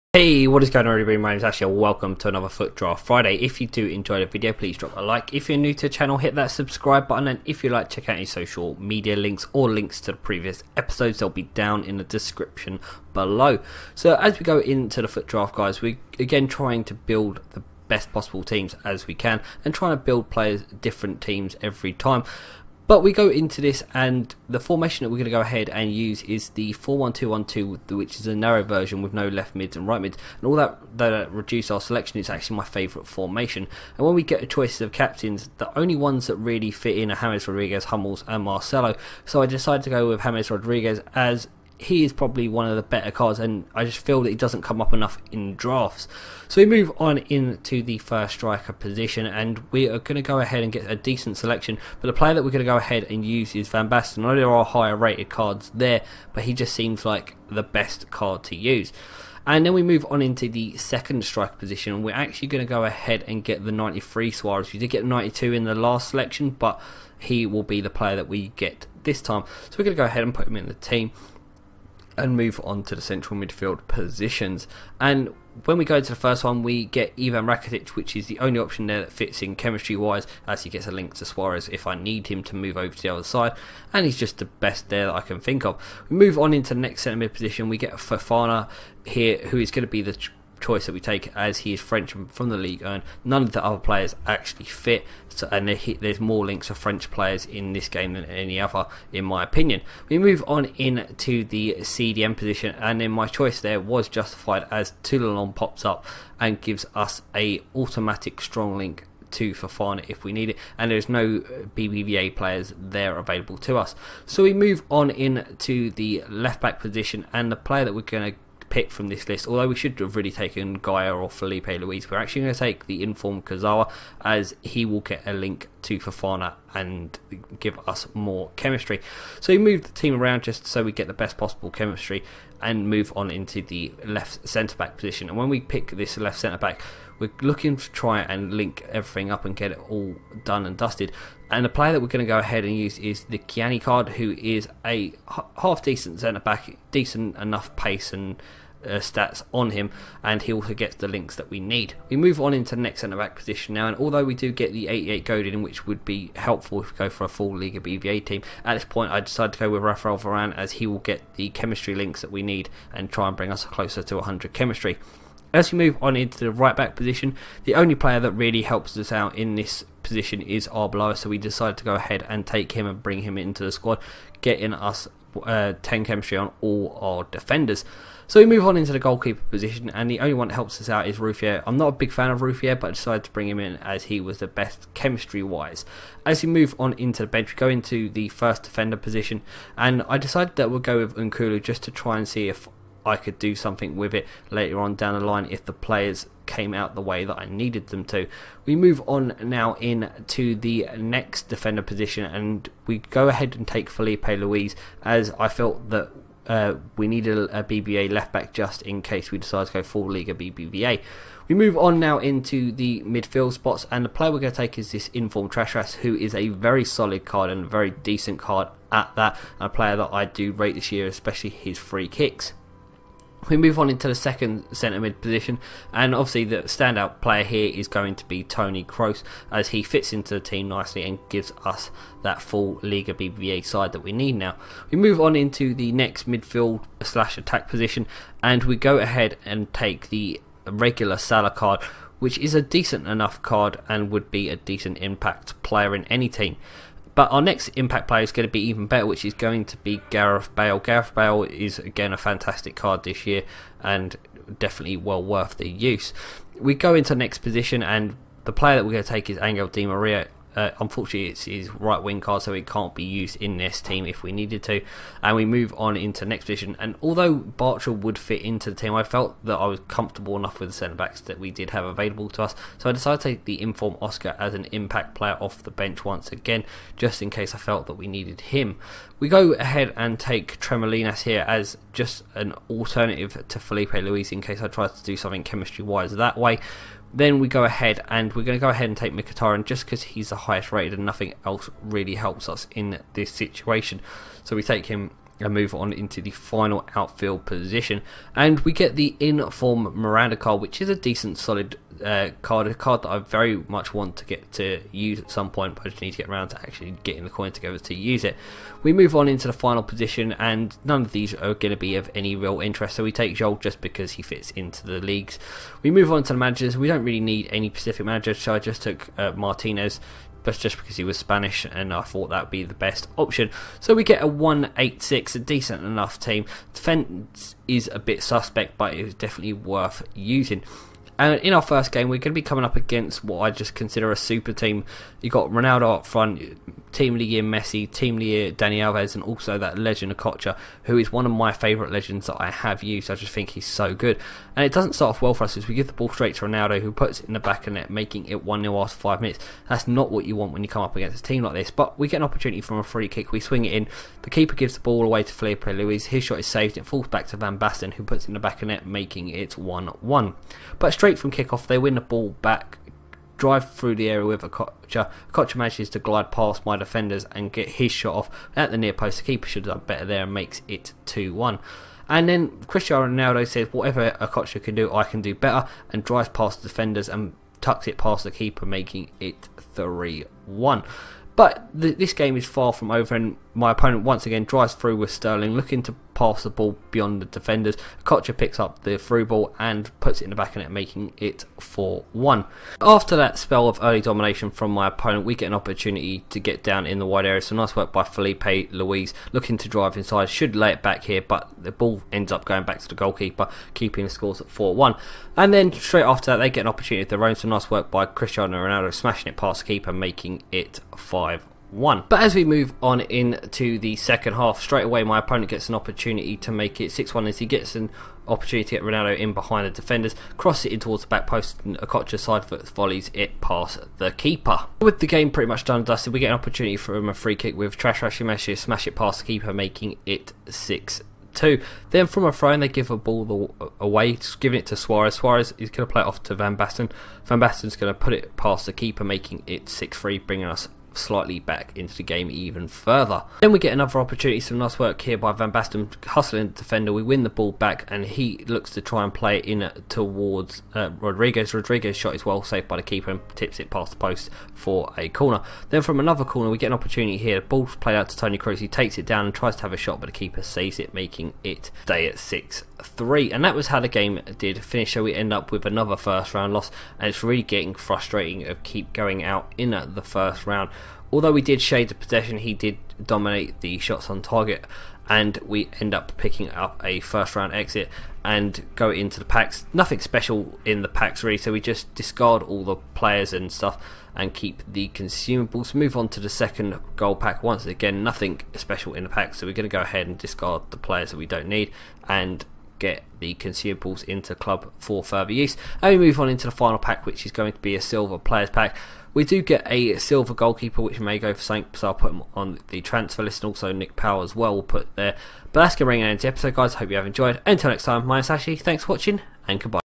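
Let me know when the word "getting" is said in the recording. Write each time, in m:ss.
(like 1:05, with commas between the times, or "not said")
2:54, 5:07, 7:47.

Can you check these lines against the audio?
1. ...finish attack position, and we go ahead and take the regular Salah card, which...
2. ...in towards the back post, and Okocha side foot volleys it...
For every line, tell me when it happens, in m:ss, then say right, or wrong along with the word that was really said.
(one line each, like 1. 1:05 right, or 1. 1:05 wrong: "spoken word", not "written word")
1. 3:57 wrong: "slash", not "finish"
2. 7:00 right.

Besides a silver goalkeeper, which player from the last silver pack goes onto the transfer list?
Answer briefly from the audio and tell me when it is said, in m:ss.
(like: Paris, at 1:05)
Nick Powell, at 8:23.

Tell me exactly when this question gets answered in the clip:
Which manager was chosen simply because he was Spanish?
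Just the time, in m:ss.
5:19.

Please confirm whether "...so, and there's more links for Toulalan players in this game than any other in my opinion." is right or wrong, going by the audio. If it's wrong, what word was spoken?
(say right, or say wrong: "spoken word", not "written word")
wrong: "French", not "Toulalan".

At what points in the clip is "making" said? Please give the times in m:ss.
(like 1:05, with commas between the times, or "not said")
5:47, 5:58, 6:18, 6:30, 6:49, 7:09, 7:19, 7:40.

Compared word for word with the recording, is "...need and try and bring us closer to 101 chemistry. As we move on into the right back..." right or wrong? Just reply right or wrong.
wrong.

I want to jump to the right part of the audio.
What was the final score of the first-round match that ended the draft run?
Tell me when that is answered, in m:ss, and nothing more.
7:42.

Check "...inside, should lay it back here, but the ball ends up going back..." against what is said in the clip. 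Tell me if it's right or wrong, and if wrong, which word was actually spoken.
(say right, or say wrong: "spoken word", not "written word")
right.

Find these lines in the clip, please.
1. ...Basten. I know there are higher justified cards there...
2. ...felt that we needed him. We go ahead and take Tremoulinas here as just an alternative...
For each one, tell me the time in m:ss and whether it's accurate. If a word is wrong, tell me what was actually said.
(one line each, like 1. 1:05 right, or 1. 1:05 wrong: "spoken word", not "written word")
1. 0:53 wrong: "rated", not "justified"
2. 4:37 right.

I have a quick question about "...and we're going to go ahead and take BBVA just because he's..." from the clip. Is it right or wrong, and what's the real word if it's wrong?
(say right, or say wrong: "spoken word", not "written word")
wrong: "Mkhitaryan", not "BBVA".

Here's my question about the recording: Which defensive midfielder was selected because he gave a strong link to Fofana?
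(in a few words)
Toulalan.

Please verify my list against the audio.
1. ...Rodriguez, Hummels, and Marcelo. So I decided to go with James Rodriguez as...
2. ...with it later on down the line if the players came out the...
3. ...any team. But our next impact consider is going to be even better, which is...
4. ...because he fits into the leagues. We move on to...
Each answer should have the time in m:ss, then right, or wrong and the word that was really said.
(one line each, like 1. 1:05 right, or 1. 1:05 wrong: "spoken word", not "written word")
1. 0:37 right
2. 3:13 right
3. 4:06 wrong: "player", not "consider"
4. 5:13 right.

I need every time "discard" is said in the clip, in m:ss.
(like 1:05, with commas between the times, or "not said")
8:01, 8:10.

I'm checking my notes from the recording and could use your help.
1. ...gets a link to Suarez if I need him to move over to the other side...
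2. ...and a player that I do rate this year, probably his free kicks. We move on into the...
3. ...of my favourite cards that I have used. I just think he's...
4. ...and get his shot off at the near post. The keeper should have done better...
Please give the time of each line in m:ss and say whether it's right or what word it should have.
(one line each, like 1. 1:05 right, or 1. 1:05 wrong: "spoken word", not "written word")
1. 1:20 right
2. 3:39 wrong: "especially", not "probably"
3. 5:41 wrong: "legends", not "cards"
4. 6:07 right.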